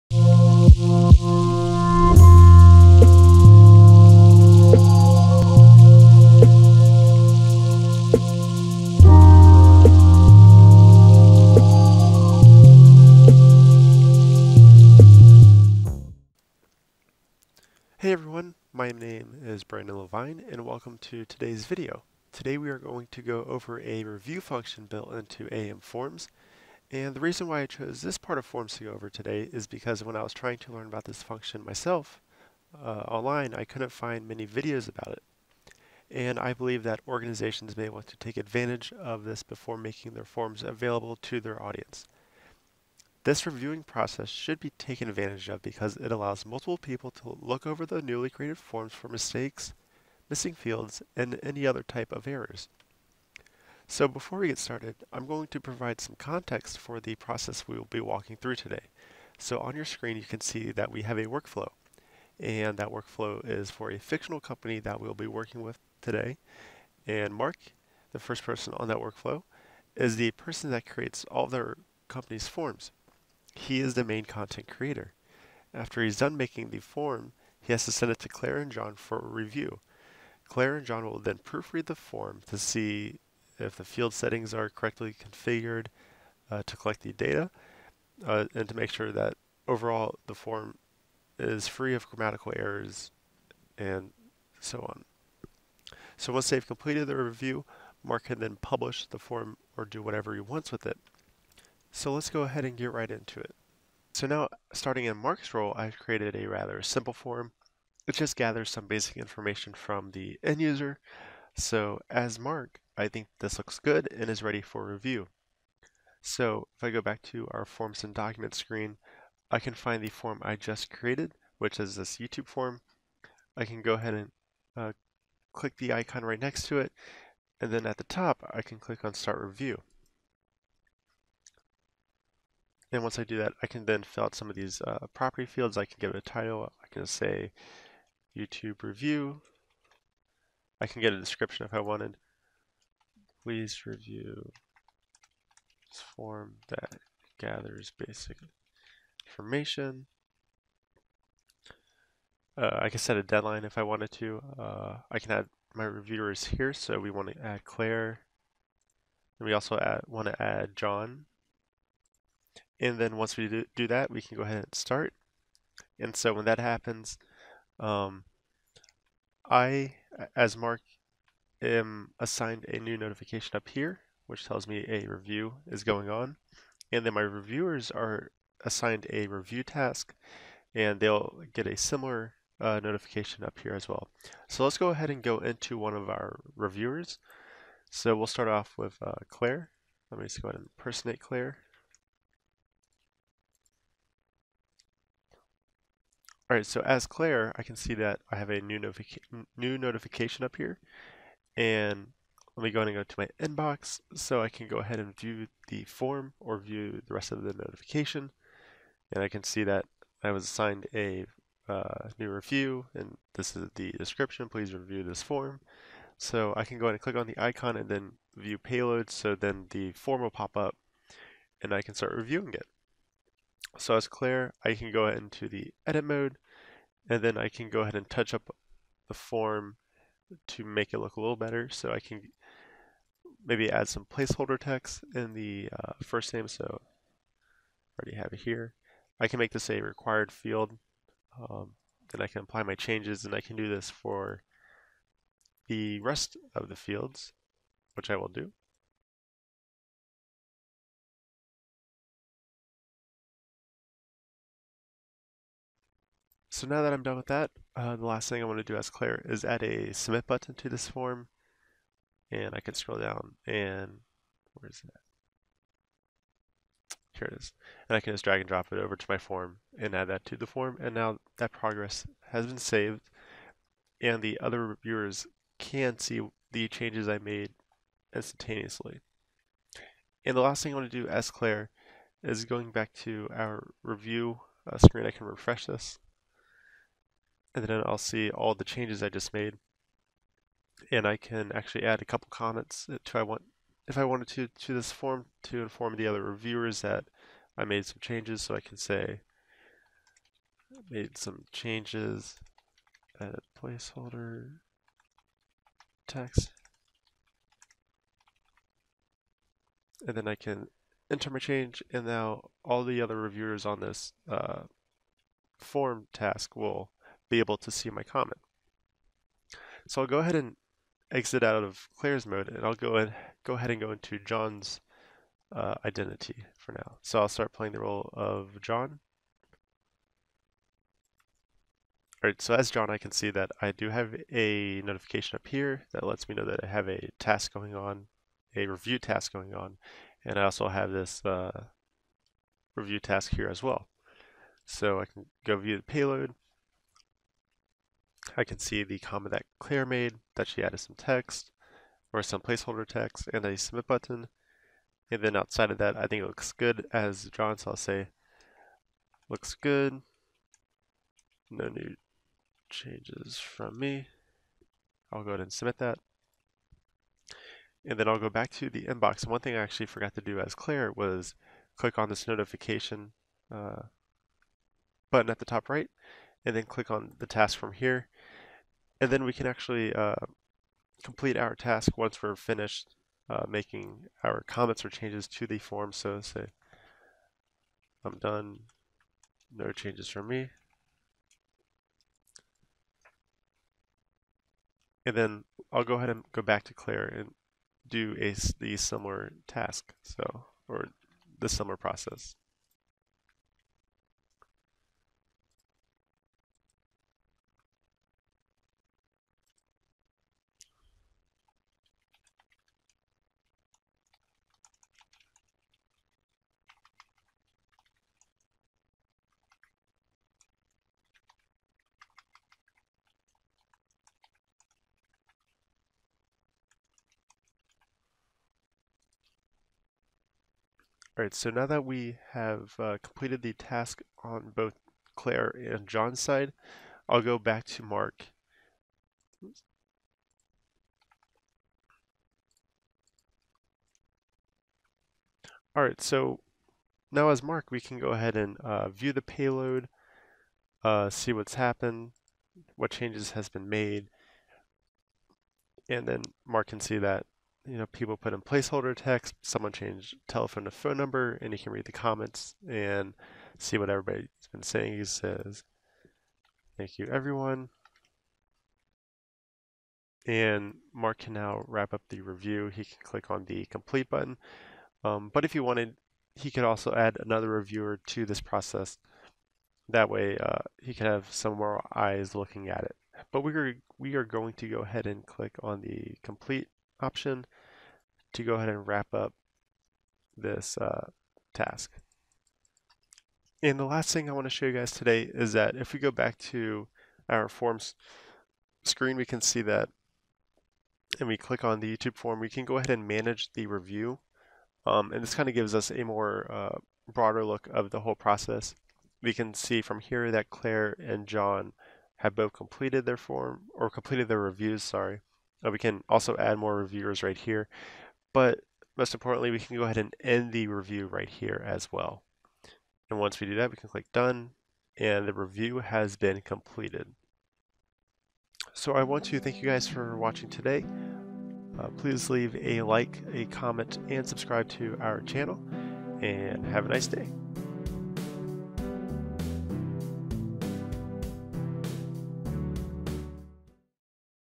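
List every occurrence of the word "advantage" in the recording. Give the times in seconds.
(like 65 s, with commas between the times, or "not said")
38 s, 45 s.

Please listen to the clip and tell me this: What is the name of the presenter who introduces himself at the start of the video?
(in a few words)
Brandon Levine.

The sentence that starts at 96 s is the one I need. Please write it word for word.
So once they've completed the review, Mark can then publish the form or do whatever he wants with it.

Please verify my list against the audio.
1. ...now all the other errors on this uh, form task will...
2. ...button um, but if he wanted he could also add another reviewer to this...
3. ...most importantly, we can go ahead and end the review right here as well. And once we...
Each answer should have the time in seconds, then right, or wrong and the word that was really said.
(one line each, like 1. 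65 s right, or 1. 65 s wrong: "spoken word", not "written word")
1. 312 s wrong: "reviewers", not "errors"
2. 474 s right
3. 518 s right.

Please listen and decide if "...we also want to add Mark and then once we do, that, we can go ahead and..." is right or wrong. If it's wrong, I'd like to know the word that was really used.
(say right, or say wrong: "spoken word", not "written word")
wrong: "John", not "Mark".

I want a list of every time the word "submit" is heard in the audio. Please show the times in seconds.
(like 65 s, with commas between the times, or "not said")
259 s, 353 s, 365 s.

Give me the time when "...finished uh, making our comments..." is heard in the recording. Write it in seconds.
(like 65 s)
382 s.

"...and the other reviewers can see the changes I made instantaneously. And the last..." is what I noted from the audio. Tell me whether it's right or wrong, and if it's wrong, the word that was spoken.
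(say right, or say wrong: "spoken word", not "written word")
right.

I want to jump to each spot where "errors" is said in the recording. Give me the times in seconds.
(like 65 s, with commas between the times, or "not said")
52 s, 92 s.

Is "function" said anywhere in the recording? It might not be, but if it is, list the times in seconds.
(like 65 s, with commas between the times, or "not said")
24 s, 31 s.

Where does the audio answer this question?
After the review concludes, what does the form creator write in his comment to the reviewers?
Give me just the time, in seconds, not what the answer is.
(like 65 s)
466 s.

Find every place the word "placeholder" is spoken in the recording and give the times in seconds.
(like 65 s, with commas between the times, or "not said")
234 s, 303 s, 352 s, 458 s.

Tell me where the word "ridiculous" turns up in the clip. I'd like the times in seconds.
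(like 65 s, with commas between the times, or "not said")
not said.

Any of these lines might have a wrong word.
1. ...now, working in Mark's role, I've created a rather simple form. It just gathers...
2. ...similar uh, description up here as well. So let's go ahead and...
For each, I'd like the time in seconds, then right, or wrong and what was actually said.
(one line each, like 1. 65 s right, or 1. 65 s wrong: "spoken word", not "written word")
1. 104 s wrong: "starting", not "working"
2. 181 s wrong: "notification", not "description".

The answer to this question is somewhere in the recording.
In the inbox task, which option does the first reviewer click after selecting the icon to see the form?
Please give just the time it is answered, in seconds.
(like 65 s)
218 s.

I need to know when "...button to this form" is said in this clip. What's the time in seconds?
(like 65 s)
260 s.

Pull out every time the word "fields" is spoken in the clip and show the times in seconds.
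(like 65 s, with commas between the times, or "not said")
50 s, 83 s, 135 s, 240 s, 246 s.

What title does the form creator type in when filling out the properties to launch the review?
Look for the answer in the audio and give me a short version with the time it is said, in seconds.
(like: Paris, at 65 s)
YouTube review, at 138 s.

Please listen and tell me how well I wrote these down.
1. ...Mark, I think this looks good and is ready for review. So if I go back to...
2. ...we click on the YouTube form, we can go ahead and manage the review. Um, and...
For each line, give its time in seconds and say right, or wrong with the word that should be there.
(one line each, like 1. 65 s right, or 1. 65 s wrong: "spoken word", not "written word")
1. 112 s right
2. 501 s right.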